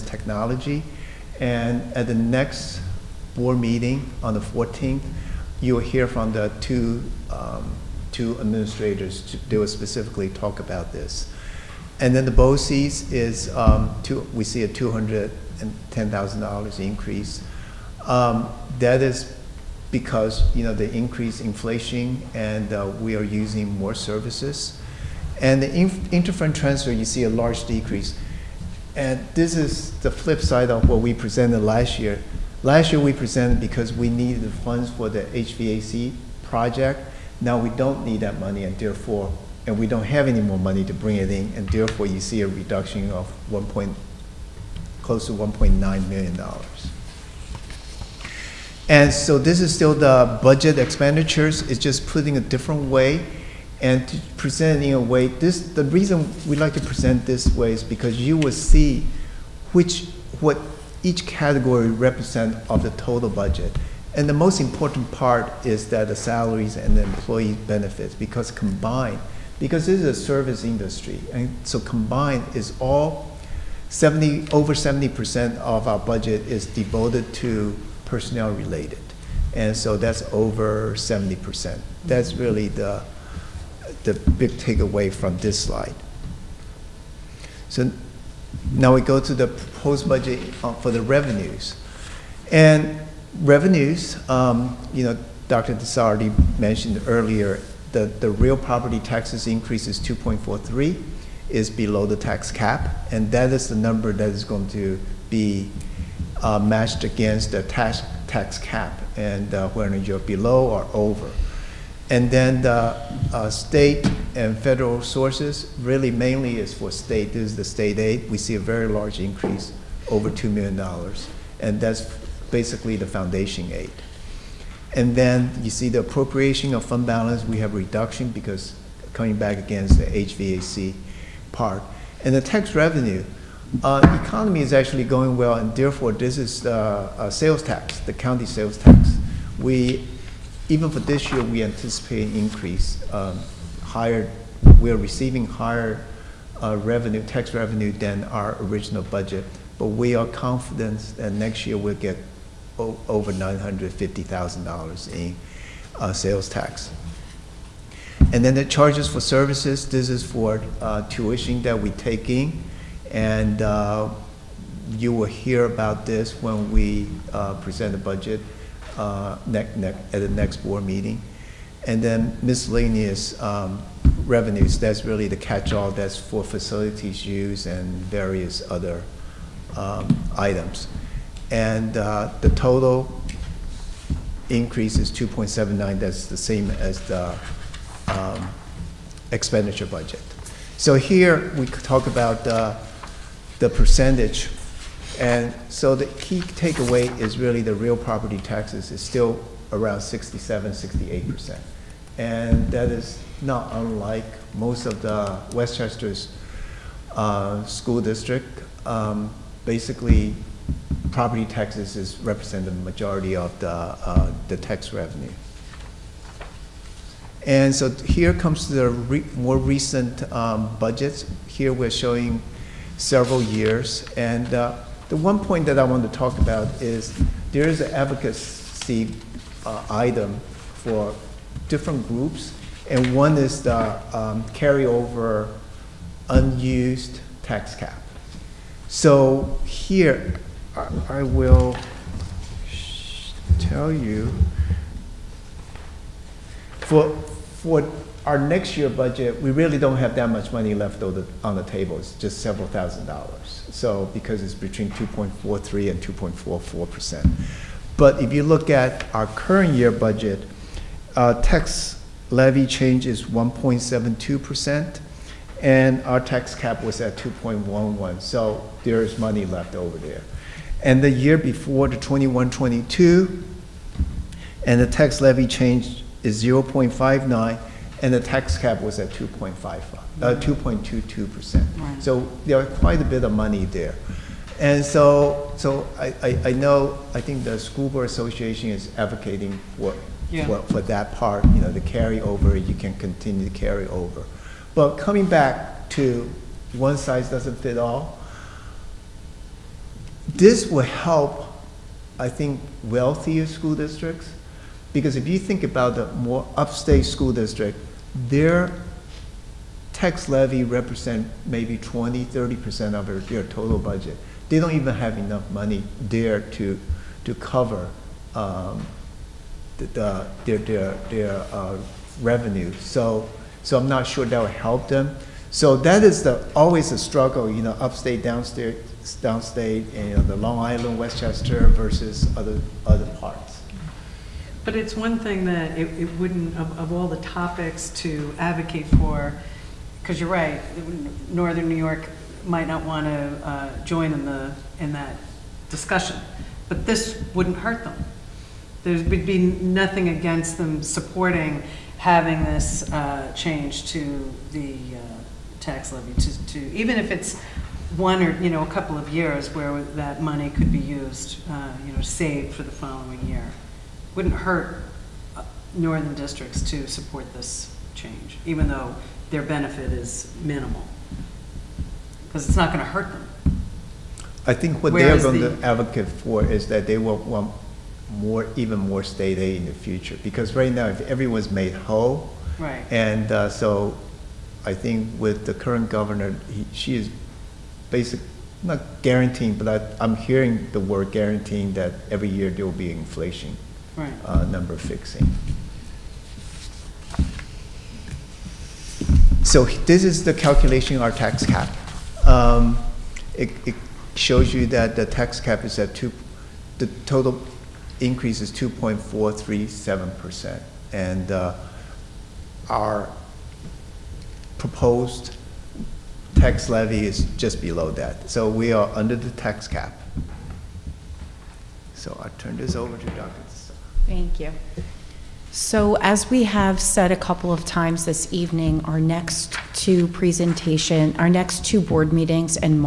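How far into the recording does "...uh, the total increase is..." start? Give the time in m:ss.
3:01.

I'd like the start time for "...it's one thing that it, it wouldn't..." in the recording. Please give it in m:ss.
5:34.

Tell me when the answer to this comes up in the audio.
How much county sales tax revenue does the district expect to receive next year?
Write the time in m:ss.
2:32.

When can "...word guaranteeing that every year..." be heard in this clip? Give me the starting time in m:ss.
6:30.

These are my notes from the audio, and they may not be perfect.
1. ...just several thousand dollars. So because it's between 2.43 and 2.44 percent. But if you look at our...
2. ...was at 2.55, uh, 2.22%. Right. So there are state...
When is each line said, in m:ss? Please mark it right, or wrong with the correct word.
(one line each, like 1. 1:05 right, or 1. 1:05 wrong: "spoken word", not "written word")
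1. 4:12 right
2. 4:38 wrong: "quite", not "state".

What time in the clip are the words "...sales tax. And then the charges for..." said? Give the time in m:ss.
2:36.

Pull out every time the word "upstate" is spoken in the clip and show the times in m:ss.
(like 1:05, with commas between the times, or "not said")
5:06, 5:27.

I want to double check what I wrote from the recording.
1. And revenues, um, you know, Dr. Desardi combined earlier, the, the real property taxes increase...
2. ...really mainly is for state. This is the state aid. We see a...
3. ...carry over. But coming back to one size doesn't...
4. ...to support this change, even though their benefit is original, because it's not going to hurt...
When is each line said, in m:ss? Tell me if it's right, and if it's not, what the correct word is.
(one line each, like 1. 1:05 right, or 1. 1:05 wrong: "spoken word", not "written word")
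1. 1:32 wrong: "mentioned", not "combined"
2. 1:55 right
3. 4:53 right
4. 6:06 wrong: "minimal", not "original".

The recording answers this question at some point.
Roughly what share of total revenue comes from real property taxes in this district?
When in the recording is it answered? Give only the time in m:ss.
3:20.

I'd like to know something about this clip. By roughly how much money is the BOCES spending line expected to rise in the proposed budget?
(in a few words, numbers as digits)
$210,000.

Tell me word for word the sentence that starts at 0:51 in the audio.
It's just put in a different way and to present in a way.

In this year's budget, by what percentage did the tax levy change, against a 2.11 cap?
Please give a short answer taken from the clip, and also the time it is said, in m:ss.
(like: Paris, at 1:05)
1.72%, at 4:23.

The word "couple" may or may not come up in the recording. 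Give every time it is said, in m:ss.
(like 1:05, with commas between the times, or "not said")
5:58, 7:07.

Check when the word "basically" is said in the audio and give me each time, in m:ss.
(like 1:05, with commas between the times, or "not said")
2:02, 3:29, 6:27.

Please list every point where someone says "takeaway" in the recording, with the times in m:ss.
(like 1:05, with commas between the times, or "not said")
1:24, 3:16.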